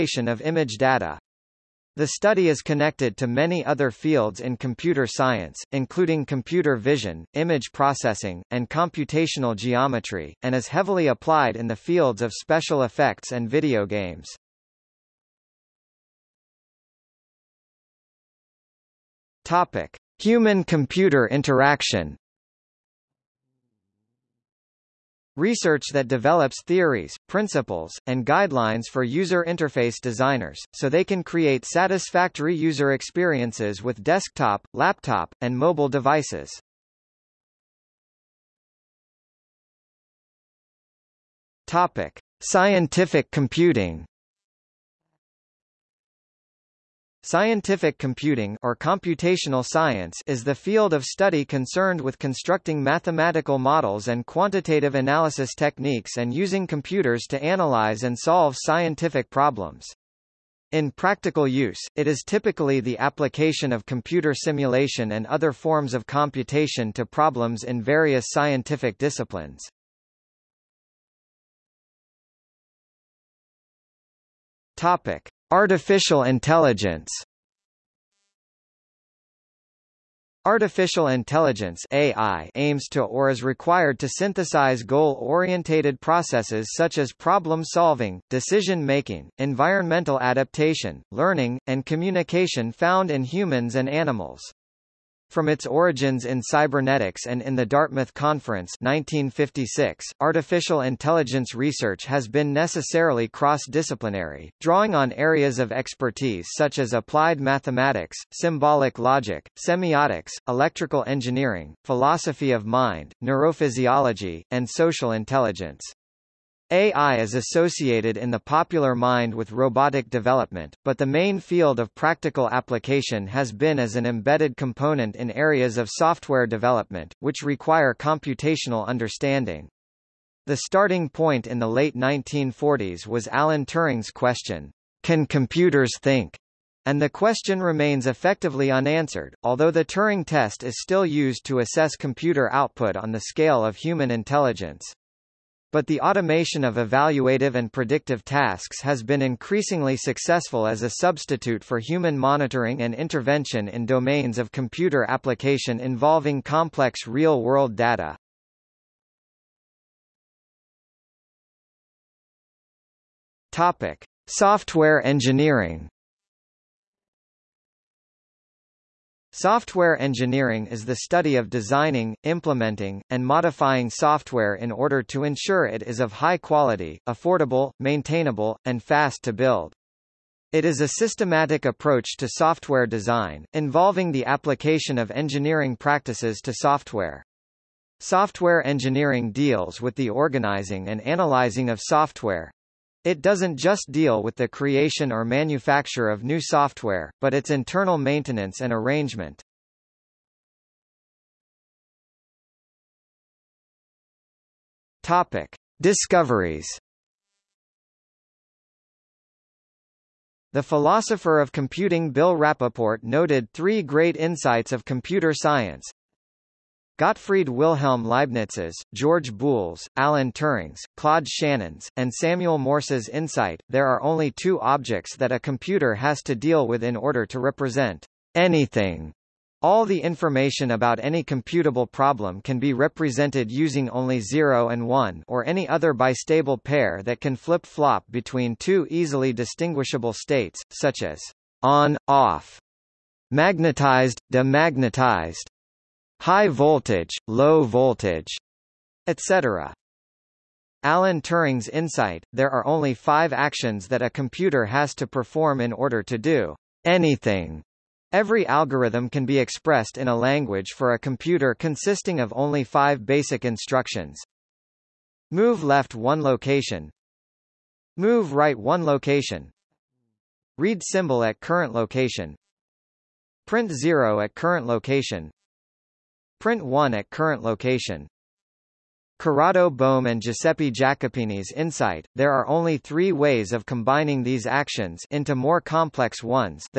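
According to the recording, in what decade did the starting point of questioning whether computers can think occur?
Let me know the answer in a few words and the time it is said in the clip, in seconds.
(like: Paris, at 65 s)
late 1940s, at 131 s.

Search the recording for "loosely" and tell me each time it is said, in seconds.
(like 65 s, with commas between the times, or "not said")
not said.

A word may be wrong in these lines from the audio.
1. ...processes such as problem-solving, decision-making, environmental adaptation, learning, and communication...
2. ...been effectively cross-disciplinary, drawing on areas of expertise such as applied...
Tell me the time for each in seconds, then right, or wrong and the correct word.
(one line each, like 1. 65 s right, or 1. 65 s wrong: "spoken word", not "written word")
1. 85 s right
2. 102 s wrong: "necessarily", not "effectively".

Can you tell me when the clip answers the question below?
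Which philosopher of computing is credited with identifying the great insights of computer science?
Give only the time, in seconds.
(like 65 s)
212 s.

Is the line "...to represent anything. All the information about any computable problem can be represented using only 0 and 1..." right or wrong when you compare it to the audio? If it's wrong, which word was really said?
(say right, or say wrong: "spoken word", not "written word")
right.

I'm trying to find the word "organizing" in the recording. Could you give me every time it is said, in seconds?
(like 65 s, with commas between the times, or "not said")
190 s.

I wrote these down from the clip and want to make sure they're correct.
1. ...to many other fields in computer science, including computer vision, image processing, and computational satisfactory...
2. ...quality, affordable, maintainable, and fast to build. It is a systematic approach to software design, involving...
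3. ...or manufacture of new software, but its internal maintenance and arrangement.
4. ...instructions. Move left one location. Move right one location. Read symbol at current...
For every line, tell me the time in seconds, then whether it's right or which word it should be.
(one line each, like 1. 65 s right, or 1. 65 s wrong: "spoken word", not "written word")
1. 3 s wrong: "geometry", not "satisfactory"
2. 176 s right
3. 195 s right
4. 263 s right.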